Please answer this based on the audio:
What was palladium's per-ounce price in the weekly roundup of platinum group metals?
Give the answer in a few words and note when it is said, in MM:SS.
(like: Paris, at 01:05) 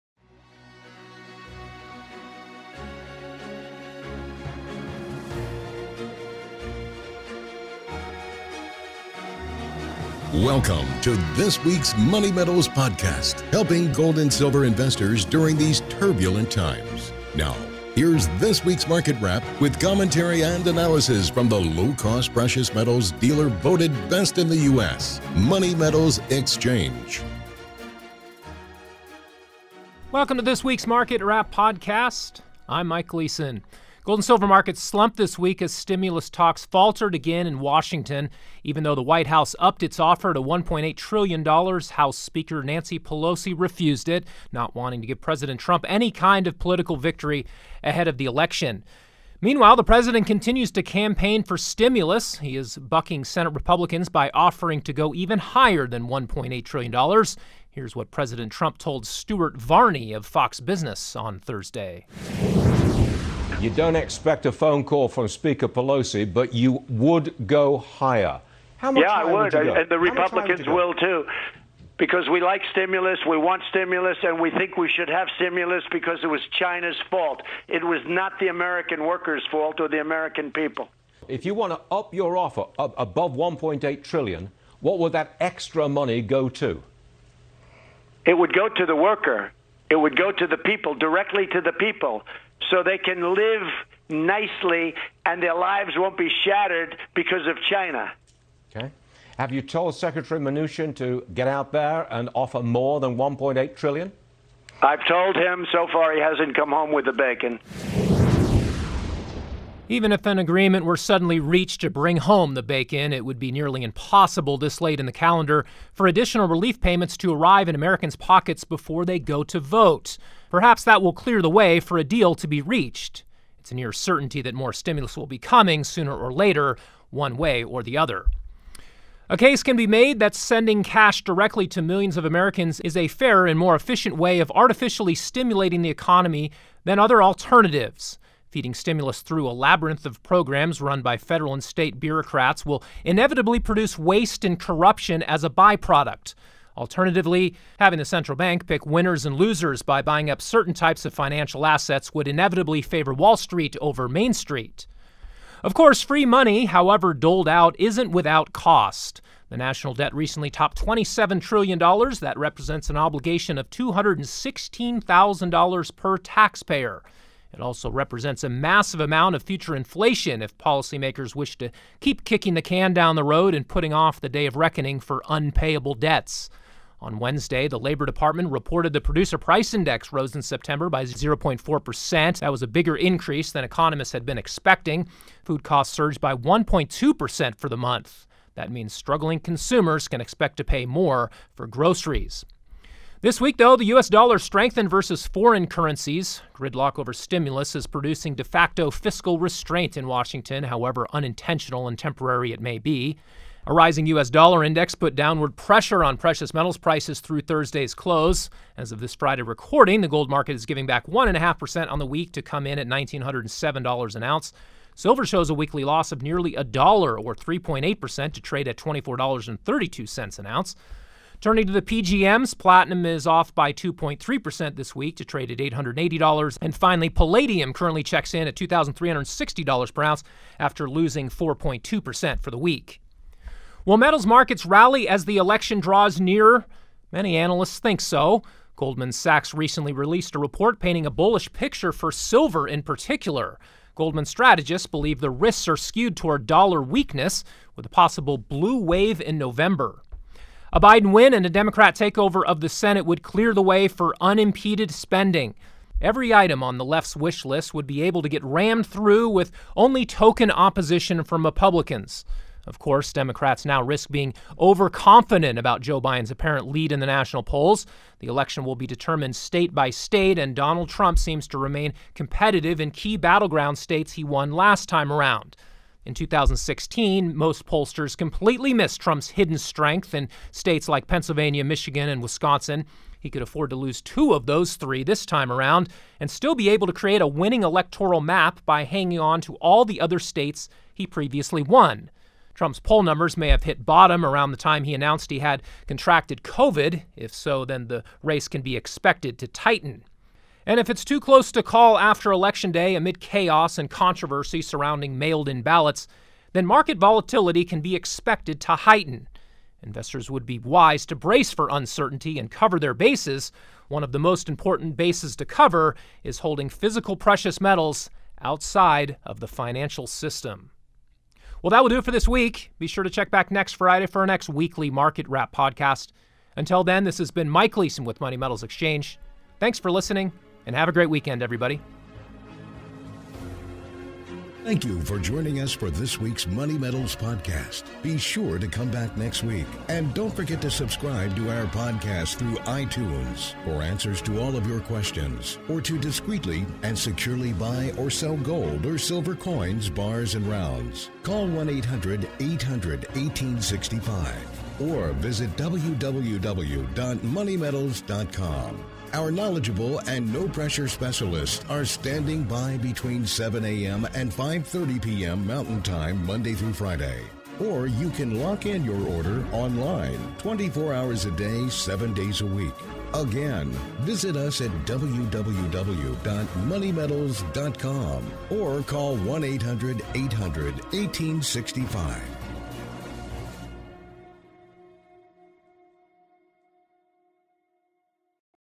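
$2,360, at 03:48.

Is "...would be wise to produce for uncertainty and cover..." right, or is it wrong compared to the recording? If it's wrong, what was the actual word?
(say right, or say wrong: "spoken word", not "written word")
wrong: "brace", not "produce".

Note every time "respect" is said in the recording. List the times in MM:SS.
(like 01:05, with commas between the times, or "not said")
not said.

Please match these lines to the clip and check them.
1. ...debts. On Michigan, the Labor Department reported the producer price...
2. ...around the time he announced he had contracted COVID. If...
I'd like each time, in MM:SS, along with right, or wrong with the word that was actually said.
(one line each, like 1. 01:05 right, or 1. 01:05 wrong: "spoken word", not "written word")
1. 02:55 wrong: "Wednesday", not "Michigan"
2. 04:54 right.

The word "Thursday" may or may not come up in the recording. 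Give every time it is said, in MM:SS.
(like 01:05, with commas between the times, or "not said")
01:01, 03:27.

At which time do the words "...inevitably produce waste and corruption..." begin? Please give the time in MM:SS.
02:23.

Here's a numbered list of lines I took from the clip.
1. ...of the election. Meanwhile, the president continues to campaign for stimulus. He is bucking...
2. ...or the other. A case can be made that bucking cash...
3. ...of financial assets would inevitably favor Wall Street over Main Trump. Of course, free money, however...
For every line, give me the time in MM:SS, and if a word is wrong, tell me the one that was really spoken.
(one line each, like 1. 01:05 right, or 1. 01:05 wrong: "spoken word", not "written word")
1. 00:48 right
2. 02:07 wrong: "sending", not "bucking"
3. 02:31 wrong: "Street", not "Trump".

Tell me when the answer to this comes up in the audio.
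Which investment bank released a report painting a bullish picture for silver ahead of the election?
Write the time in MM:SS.
03:58.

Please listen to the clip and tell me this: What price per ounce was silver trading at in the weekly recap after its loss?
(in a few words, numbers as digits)
$24.32.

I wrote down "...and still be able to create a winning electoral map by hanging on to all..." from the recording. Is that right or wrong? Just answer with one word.
right.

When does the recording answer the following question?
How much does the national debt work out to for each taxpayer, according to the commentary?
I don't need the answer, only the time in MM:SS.
02:43.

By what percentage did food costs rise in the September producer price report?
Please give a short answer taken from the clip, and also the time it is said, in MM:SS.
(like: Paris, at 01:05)
1.2%, at 03:06.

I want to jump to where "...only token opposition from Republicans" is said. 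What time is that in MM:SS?
04:19.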